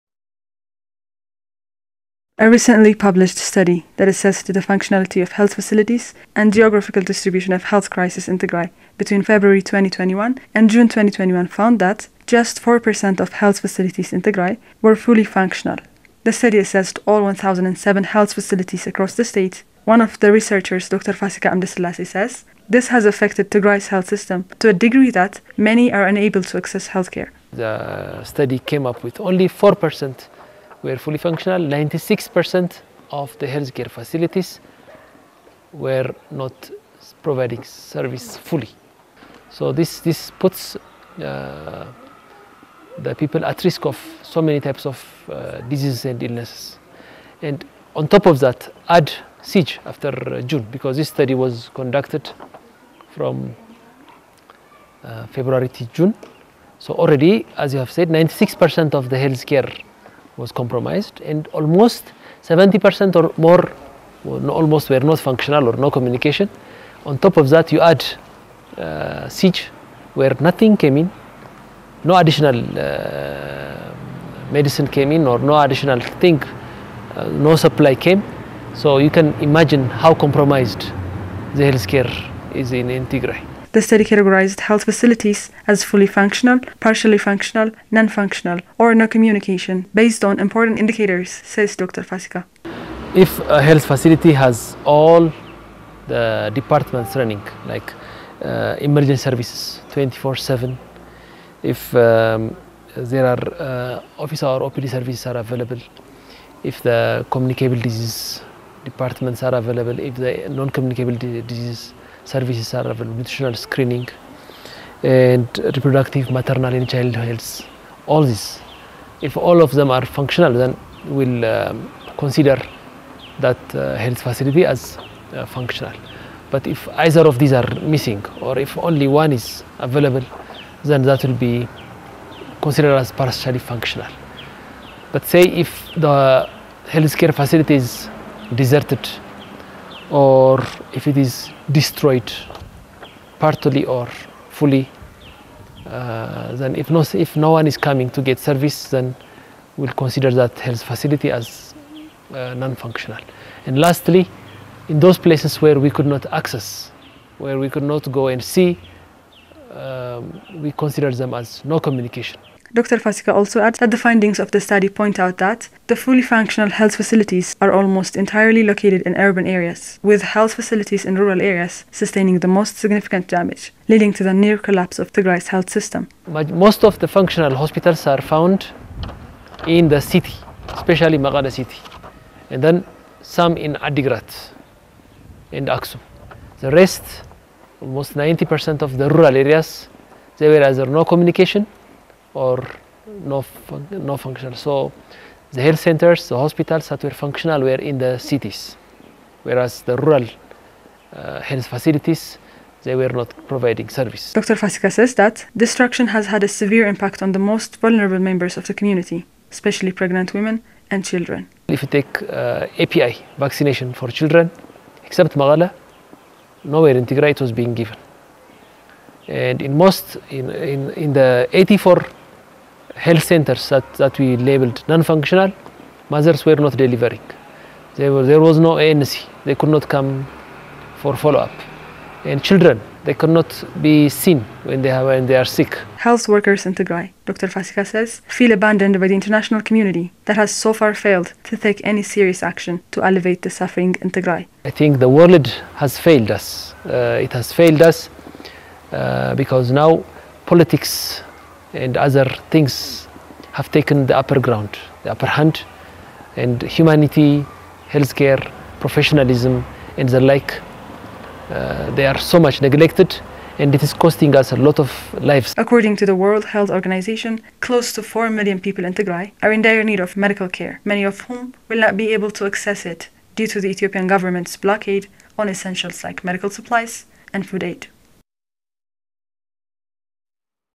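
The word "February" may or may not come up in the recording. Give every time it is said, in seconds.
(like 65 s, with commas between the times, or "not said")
9 s, 55 s.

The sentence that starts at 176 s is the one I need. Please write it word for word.
But most of the functional hospitals are found in the city, especially Mekelle city, and then some in Adigrat and Aksum.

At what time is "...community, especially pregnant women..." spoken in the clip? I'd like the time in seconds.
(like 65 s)
208 s.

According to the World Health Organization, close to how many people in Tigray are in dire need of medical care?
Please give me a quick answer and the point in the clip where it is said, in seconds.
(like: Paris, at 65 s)
4 million, at 268 s.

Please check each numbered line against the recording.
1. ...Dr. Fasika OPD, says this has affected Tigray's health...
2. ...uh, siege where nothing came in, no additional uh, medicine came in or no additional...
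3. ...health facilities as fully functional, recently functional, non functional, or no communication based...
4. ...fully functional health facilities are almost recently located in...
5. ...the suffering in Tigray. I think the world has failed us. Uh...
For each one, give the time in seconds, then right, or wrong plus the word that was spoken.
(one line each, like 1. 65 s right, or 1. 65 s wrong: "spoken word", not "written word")
1. 20 s wrong: "Amdesilasi", not "OPD"
2. 68 s right
3. 84 s wrong: "partially", not "recently"
4. 165 s wrong: "entirely", not "recently"
5. 243 s right.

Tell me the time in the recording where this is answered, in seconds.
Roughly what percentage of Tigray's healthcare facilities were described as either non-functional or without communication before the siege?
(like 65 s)
62 s.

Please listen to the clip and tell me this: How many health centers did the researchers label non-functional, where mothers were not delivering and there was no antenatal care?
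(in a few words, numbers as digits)
84.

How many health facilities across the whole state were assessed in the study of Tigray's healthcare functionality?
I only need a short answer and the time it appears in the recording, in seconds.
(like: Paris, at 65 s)
1007, at 17 s.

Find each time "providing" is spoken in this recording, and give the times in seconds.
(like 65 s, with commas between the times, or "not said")
37 s, 203 s.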